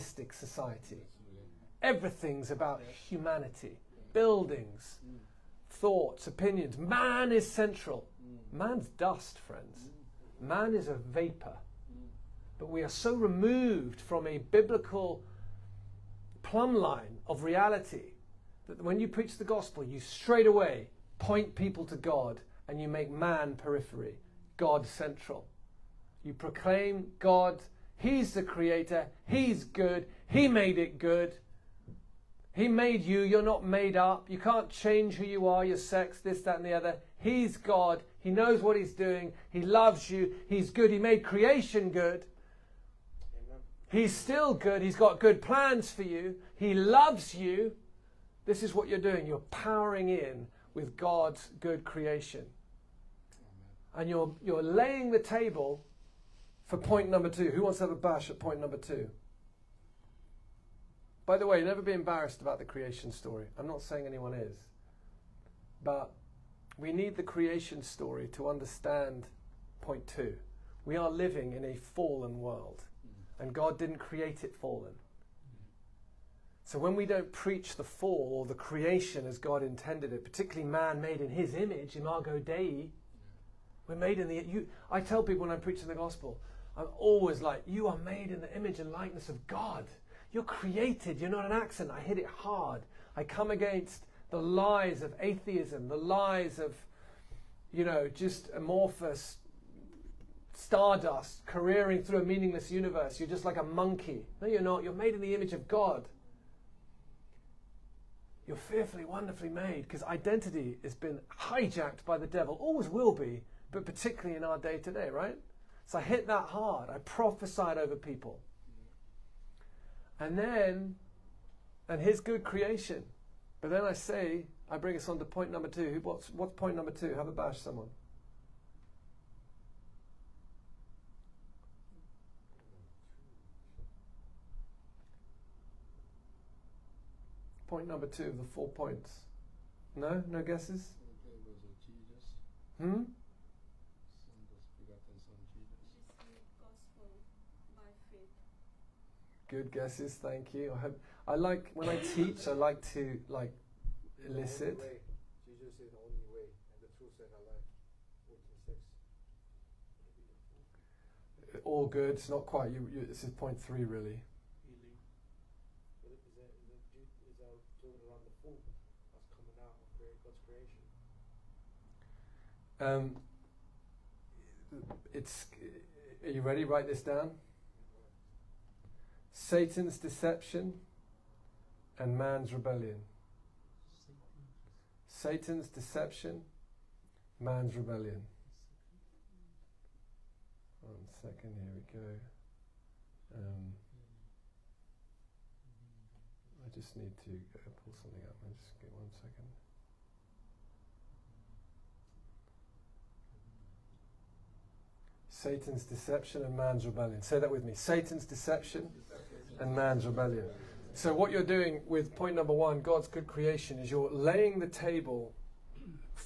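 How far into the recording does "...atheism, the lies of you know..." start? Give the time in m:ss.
1:35.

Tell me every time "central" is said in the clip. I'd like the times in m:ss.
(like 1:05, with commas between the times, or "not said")
0:07, 0:24.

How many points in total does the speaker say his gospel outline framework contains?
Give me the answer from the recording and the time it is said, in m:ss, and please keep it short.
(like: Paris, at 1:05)
4, at 2:18.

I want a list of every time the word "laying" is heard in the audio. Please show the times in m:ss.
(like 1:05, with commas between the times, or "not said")
0:54, 3:34.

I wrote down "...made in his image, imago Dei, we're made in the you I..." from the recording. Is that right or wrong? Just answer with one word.
right.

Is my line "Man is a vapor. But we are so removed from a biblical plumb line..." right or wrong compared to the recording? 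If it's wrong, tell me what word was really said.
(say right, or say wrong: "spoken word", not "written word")
right.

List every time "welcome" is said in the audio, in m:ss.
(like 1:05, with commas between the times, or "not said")
not said.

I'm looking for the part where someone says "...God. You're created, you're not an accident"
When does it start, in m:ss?
1:29.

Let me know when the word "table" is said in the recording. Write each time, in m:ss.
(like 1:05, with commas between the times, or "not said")
0:55, 3:34.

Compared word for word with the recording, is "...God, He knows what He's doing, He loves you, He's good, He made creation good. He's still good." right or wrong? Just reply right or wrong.
right.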